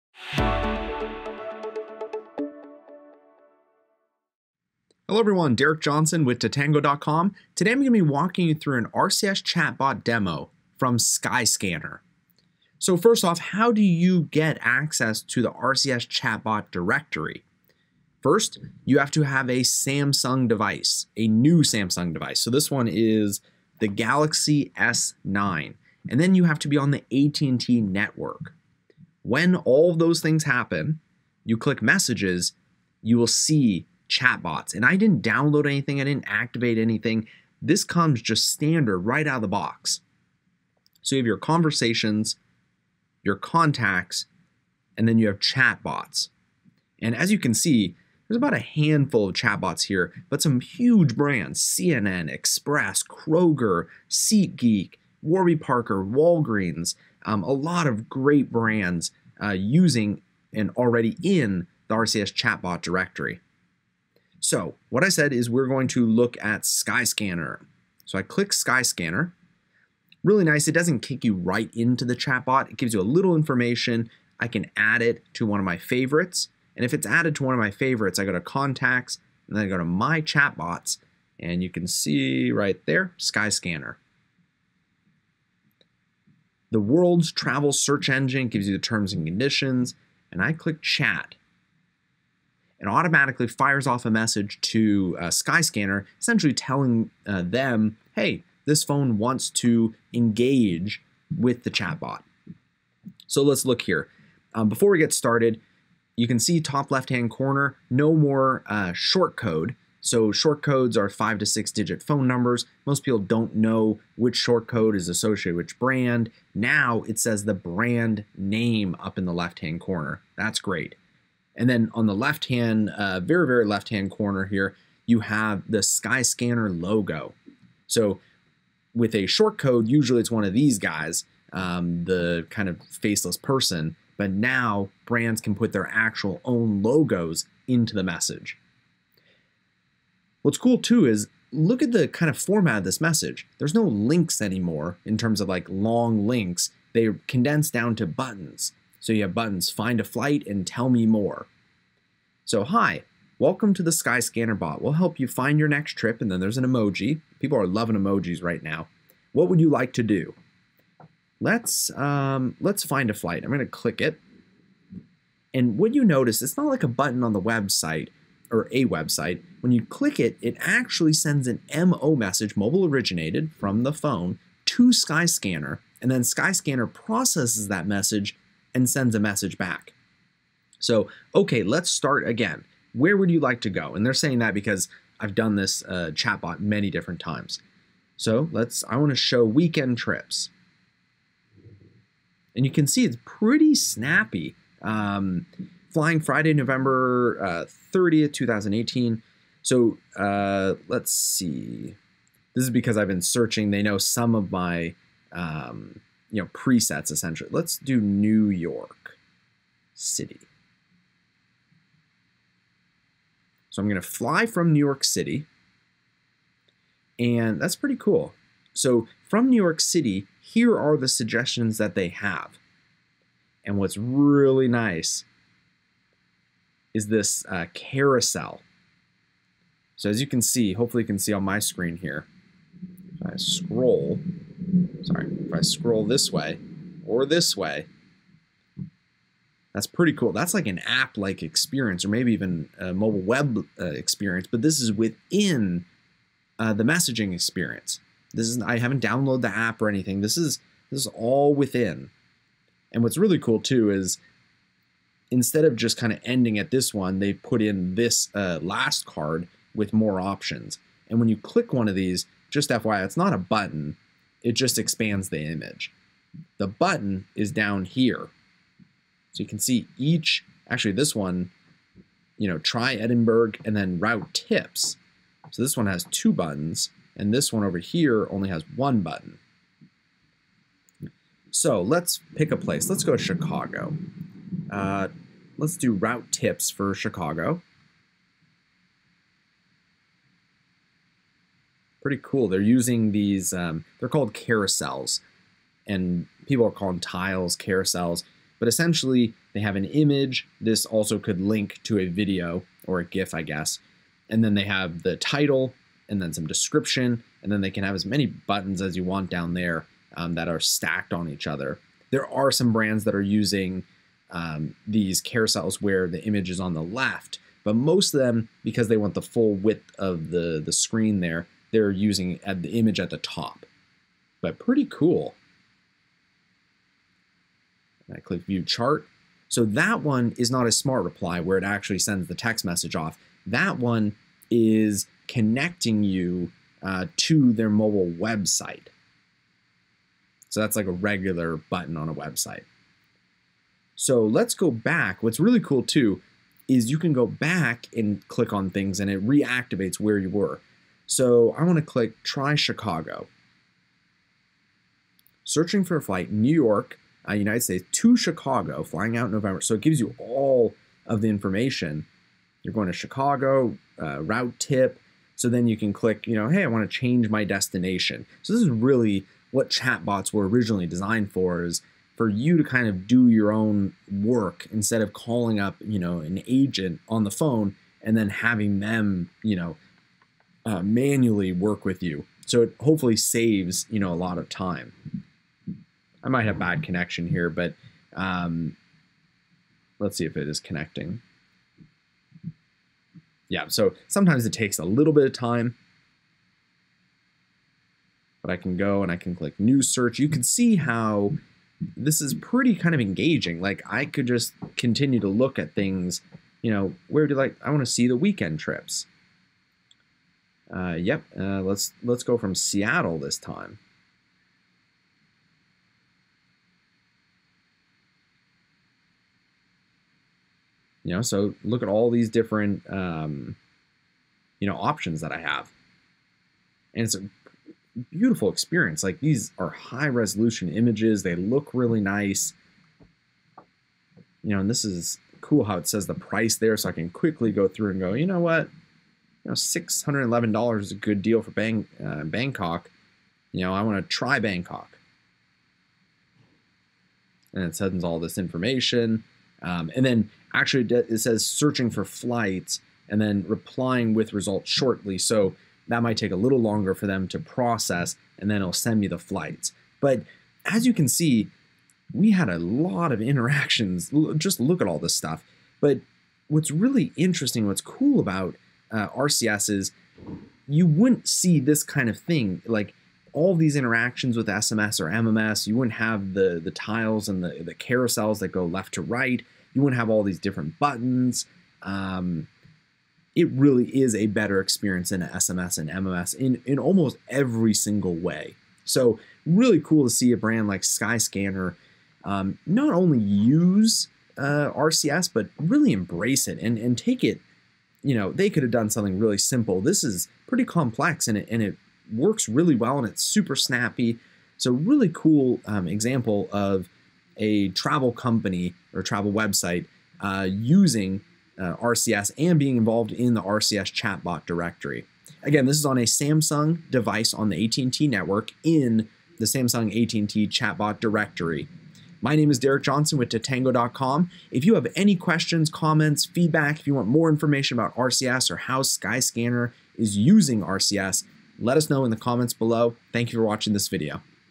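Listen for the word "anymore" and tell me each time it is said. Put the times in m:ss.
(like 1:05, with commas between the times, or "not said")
2:24.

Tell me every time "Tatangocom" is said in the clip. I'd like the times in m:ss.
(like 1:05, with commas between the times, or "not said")
0:06, 8:43.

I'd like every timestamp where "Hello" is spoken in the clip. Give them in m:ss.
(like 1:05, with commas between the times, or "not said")
0:05.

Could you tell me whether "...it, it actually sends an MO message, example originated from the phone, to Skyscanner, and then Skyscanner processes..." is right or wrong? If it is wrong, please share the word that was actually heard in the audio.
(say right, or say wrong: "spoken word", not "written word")
wrong: "mobile", not "example".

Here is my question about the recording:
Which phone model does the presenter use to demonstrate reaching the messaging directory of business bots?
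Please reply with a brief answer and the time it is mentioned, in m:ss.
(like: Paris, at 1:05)
Galaxy S9, at 0:23.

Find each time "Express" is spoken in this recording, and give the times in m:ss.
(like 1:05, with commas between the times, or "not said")
0:52.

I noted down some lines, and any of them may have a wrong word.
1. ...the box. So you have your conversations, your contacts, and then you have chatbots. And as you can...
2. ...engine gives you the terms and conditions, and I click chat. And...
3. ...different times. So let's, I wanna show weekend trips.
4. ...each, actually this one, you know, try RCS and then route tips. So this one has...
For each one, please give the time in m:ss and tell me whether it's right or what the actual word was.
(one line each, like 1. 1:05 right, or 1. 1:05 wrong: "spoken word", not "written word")
1. 0:39 right
2. 1:28 right
3. 3:06 right
4. 4:29 wrong: "Edinburgh", not "RCS".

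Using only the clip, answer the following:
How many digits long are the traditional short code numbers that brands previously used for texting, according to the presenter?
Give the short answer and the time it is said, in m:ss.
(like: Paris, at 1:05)
5 to 6, at 1:51.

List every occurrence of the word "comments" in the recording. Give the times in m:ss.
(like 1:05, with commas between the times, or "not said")
8:45, 8:52.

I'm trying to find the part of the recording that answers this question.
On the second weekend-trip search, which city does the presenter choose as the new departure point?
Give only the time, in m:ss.
6:52.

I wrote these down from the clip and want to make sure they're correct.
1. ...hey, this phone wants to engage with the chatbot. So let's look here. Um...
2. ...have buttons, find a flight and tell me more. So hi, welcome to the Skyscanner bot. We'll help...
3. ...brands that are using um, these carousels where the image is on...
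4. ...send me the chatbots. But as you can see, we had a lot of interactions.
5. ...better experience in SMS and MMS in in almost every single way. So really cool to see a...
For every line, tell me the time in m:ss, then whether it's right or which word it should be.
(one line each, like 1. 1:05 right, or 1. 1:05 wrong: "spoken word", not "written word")
1. 1:38 right
2. 2:29 right
3. 5:12 right
4. 7:38 wrong: "flights", not "chatbots"
5. 8:04 right.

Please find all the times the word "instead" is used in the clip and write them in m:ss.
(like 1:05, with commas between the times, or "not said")
4:15, 6:14.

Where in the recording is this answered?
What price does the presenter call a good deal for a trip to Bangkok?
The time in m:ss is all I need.
7:19.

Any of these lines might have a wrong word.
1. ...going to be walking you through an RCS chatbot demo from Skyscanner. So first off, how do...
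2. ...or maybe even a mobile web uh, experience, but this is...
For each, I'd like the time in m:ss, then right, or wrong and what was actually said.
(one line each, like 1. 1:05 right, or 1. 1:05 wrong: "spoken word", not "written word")
1. 0:07 right
2. 4:02 right.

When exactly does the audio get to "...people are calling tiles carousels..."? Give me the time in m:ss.
4:56.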